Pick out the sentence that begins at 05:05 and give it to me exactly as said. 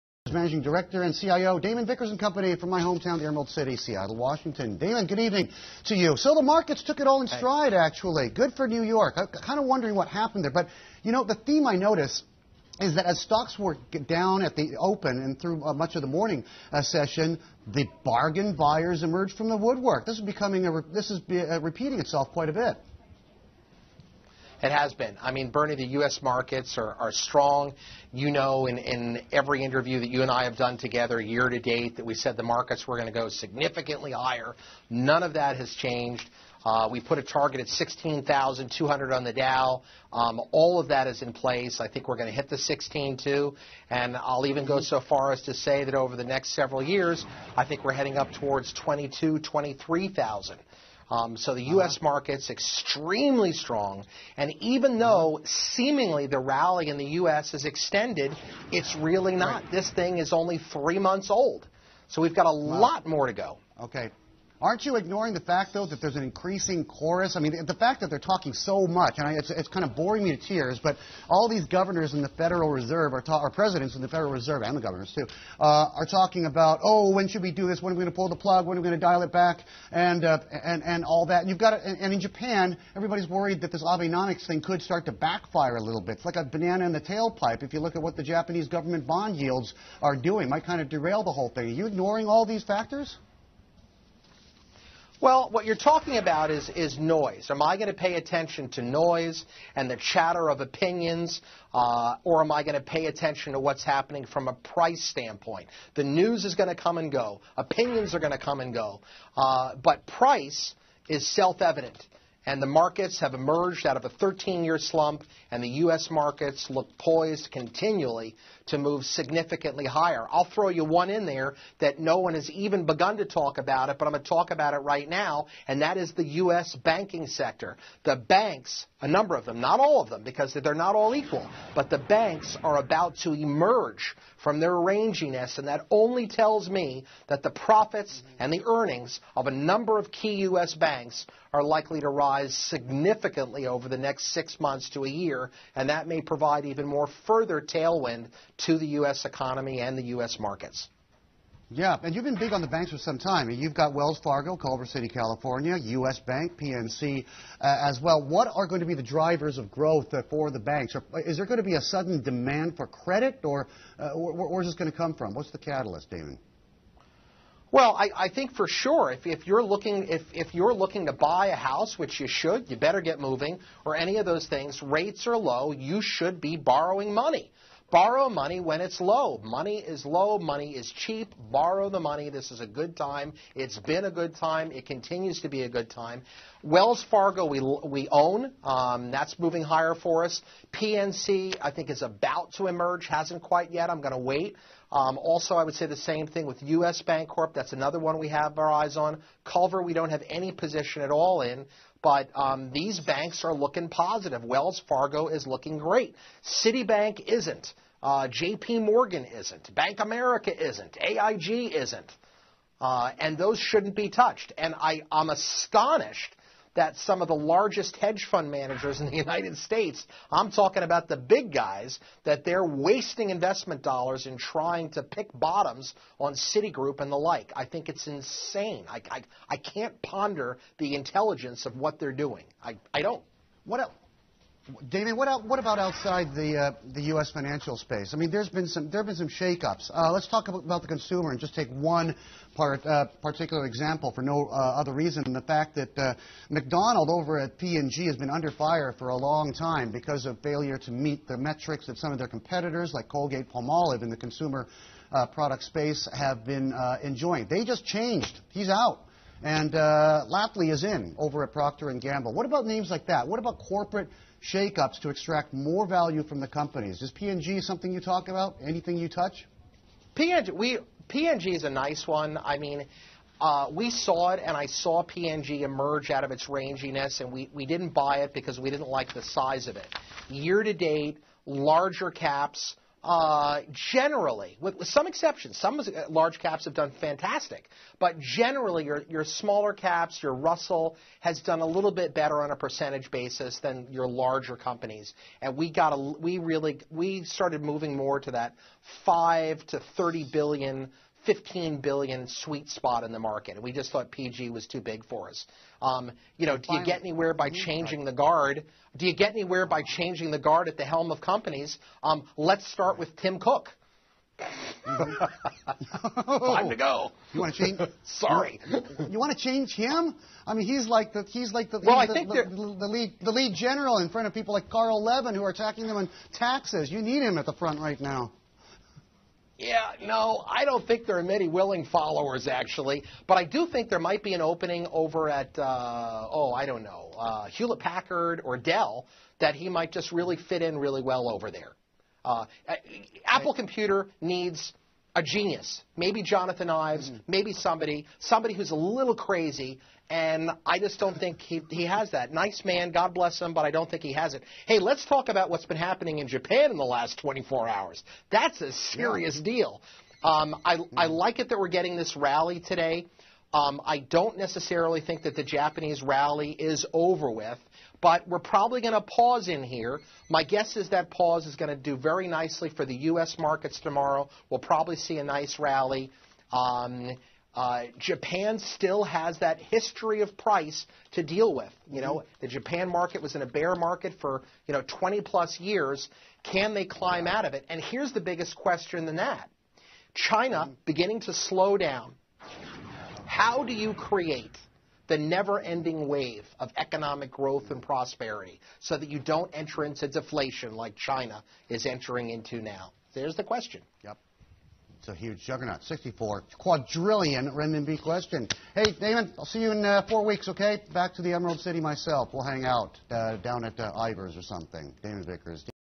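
Um, you know, do you get anywhere by changing the guard?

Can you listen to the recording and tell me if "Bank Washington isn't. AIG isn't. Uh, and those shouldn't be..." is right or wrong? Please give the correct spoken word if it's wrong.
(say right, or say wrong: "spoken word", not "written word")
wrong: "America", not "Washington".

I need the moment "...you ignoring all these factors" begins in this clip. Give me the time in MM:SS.
01:31.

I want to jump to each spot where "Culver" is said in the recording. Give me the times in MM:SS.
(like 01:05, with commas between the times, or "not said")
02:34, 03:19.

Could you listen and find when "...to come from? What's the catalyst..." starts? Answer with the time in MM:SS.
02:44.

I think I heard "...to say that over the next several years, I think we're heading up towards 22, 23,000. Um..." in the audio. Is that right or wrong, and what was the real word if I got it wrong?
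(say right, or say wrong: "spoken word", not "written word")
right.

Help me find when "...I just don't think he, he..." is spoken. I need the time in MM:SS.
05:50.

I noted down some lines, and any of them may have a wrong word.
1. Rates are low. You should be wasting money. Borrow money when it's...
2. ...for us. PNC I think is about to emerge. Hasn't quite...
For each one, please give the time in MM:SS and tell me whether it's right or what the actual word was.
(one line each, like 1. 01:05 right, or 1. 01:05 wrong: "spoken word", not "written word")
1. 02:54 wrong: "borrowing", not "wasting"
2. 03:09 right.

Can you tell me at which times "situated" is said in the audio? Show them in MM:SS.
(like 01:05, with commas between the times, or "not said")
not said.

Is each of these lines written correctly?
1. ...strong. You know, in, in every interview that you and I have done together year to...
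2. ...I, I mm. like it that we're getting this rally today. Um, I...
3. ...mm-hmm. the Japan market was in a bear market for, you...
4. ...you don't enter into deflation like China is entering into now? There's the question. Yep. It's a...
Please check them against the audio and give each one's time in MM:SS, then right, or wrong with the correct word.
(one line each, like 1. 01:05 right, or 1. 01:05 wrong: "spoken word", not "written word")
1. 00:27 right
2. 06:00 right
3. 06:22 right
4. 06:39 right.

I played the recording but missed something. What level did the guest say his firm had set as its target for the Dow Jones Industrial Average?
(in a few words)
16,200.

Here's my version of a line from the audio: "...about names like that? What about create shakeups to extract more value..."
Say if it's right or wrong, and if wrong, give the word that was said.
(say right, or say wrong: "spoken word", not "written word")
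wrong: "corporate", not "create".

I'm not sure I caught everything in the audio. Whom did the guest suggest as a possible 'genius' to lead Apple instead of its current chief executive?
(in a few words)
Jonathan Ives.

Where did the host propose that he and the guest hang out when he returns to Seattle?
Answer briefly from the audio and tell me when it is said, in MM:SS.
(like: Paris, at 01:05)
Ivar's, at 06:54.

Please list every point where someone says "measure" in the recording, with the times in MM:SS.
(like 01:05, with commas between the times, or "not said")
not said.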